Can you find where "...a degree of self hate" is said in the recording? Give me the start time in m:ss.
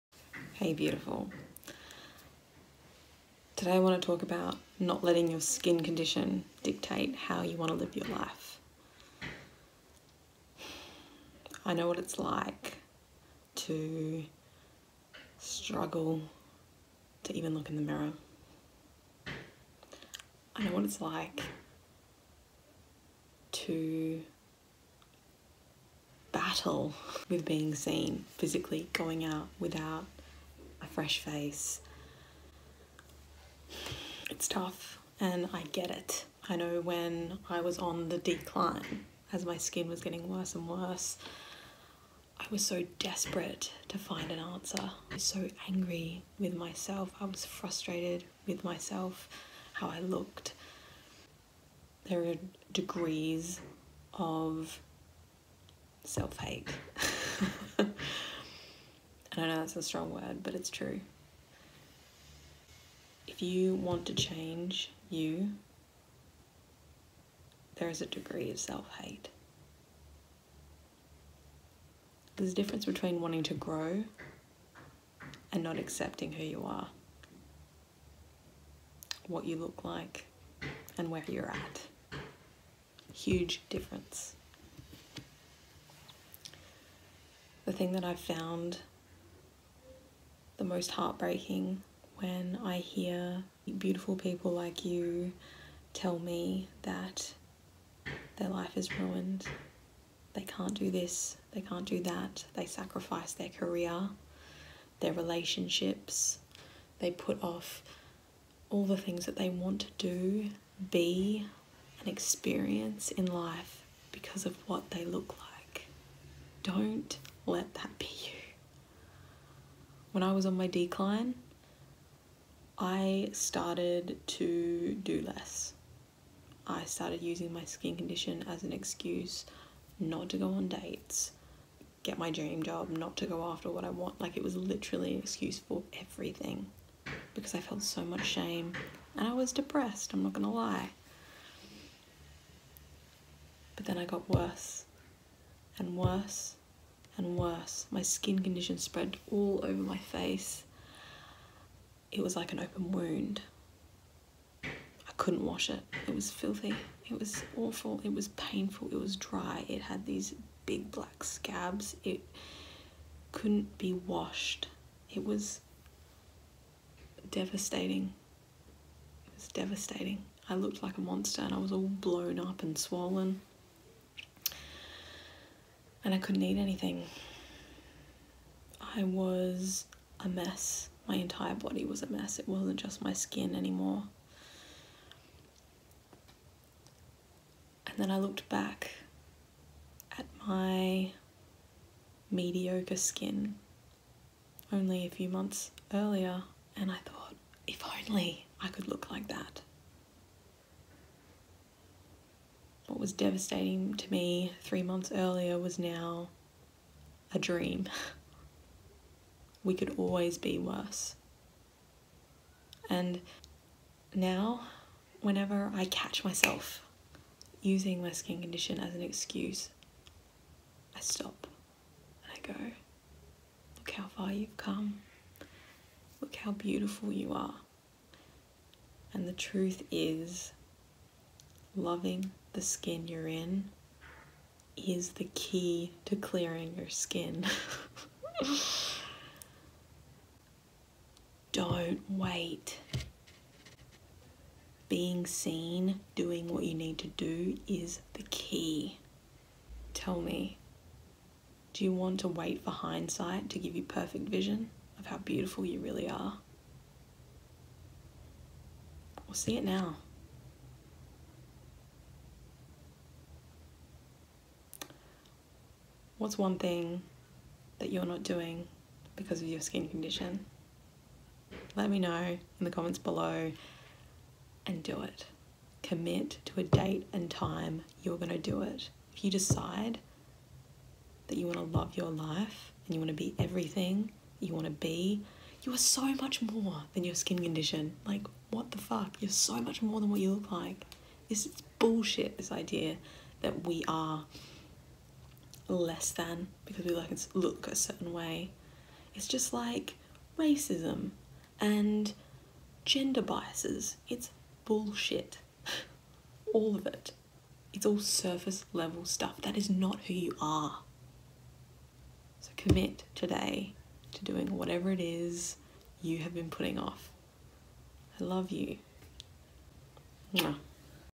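1:08.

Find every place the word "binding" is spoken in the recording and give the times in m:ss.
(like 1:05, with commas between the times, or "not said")
not said.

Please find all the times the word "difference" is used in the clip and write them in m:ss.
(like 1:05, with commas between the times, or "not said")
1:12, 1:23.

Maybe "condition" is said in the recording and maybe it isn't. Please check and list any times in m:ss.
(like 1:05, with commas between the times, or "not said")
0:05, 2:07, 2:28, 3:38, 4:29, 4:47.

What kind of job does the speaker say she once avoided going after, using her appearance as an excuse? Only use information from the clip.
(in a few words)
Dream job.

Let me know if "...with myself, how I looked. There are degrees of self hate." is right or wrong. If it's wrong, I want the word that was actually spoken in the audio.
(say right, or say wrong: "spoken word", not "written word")
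right.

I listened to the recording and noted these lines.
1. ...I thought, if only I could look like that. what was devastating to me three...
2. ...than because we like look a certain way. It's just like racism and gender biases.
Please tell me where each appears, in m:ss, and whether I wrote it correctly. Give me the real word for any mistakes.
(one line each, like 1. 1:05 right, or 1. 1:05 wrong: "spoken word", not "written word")
1. 3:16 right
2. 4:56 right.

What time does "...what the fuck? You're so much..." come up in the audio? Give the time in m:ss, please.
4:48.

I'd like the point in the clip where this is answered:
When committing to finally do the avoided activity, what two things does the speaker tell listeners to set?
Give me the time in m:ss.
4:36.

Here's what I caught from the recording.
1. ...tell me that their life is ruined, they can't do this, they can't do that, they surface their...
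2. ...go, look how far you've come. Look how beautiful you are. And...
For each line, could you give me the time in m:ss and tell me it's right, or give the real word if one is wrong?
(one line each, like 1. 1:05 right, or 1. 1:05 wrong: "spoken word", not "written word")
1. 1:35 wrong: "sacrifice", not "surface"
2. 3:42 right.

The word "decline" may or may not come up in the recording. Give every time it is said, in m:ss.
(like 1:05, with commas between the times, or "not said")
0:38, 2:00.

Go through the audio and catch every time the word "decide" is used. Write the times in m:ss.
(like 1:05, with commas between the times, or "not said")
4:39.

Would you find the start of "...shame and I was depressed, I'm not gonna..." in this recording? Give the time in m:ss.
2:18.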